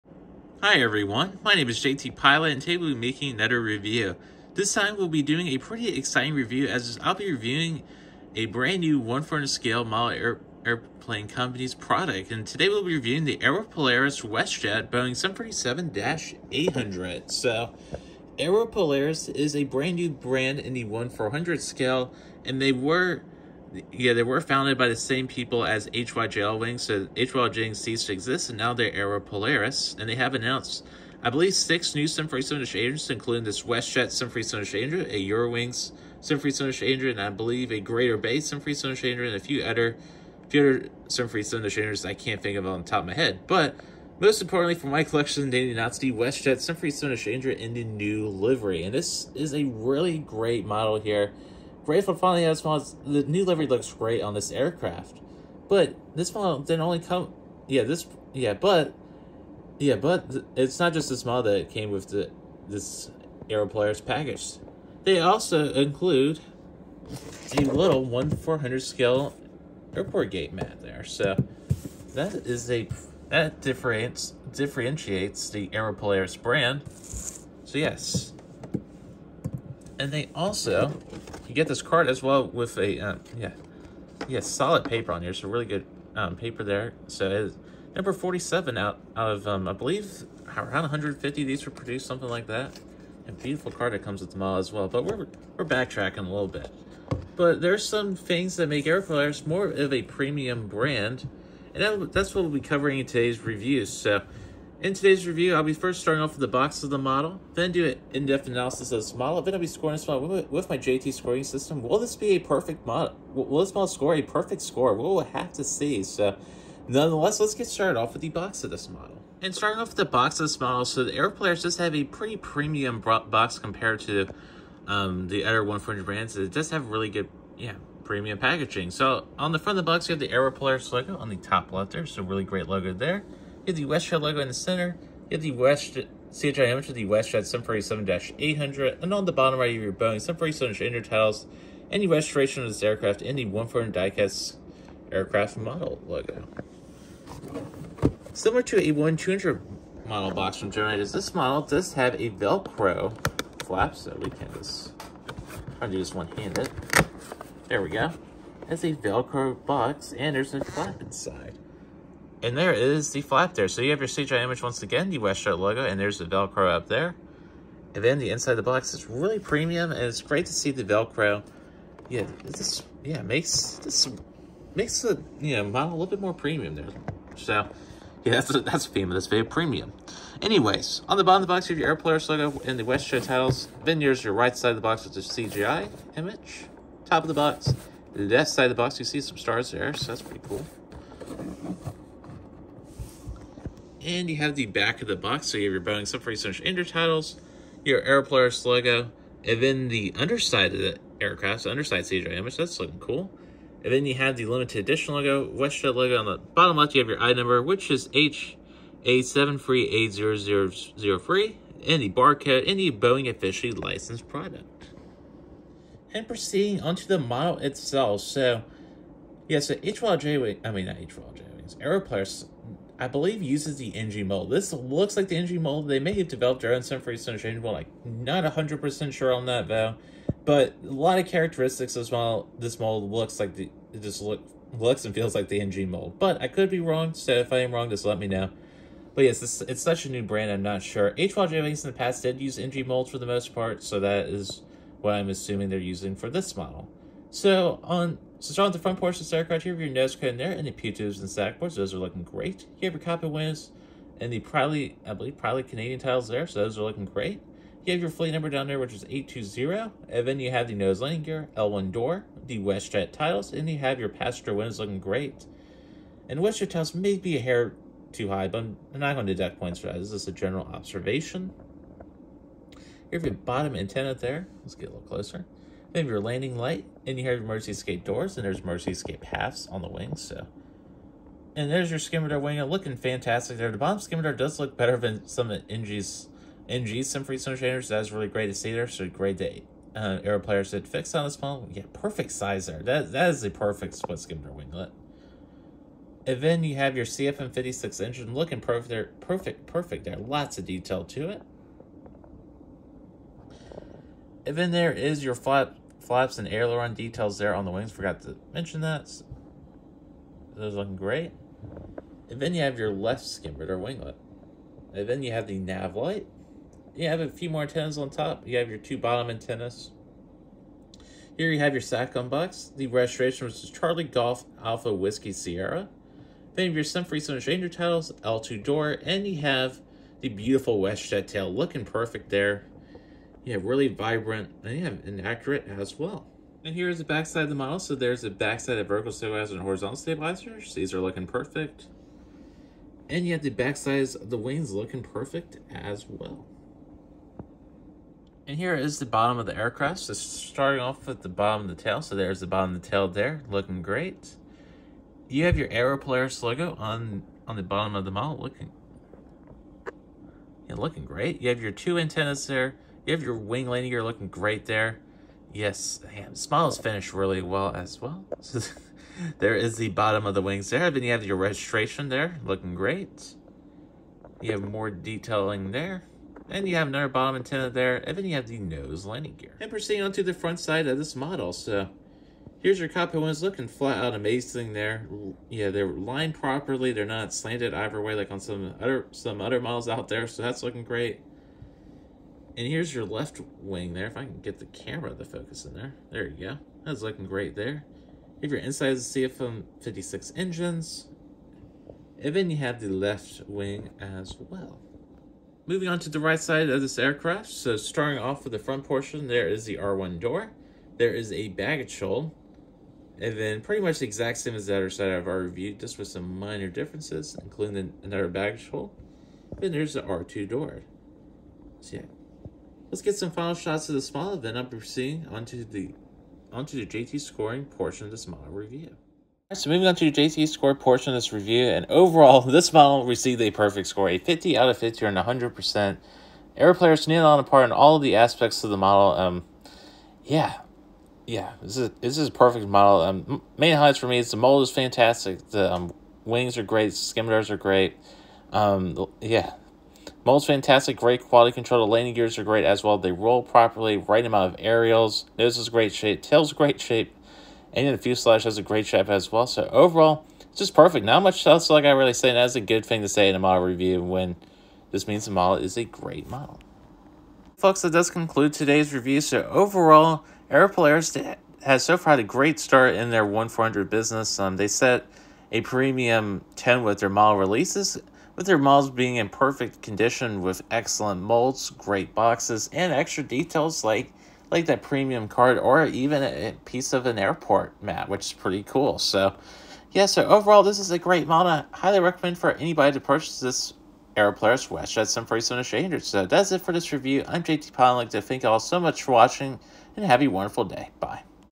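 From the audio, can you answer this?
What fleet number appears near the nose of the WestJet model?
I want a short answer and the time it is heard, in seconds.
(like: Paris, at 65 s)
820, at 259 s.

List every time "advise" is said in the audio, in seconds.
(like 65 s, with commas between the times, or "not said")
not said.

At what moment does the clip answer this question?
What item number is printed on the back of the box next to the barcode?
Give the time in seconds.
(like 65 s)
208 s.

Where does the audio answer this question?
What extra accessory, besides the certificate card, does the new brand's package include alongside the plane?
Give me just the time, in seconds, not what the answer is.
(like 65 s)
69 s.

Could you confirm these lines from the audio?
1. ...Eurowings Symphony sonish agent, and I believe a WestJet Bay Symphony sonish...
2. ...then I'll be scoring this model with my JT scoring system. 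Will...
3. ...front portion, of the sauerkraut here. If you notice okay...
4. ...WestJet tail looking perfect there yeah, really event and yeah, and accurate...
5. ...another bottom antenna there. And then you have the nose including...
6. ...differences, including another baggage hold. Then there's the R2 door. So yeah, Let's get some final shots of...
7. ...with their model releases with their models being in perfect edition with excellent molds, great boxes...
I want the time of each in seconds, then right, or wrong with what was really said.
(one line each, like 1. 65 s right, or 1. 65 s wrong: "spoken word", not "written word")
1. 35 s wrong: "Greater", not "WestJet"
2. 109 s right
3. 248 s right
4. 330 s wrong: "vibrant", not "event"
5. 376 s wrong: "landing", not "including"
6. 416 s right
7. 476 s wrong: "condition", not "edition".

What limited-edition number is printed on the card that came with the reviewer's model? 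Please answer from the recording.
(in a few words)
47.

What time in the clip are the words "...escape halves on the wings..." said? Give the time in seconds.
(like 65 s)
278 s.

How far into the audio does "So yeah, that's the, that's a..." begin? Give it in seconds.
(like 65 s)
177 s.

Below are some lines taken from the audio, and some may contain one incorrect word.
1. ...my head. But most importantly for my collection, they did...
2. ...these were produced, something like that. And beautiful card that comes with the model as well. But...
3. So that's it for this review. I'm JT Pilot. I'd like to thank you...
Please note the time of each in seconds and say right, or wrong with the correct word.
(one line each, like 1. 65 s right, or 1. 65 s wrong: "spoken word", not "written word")
1. 43 s right
2. 91 s right
3. 496 s right.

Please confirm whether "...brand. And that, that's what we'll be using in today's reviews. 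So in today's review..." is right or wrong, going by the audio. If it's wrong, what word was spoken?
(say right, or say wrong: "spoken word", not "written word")
wrong: "covering", not "using".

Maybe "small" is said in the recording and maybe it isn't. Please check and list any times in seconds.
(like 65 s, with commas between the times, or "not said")
424 s.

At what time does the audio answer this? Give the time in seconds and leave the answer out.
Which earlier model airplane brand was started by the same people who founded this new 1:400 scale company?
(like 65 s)
25 s.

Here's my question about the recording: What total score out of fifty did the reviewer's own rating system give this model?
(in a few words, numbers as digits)
50.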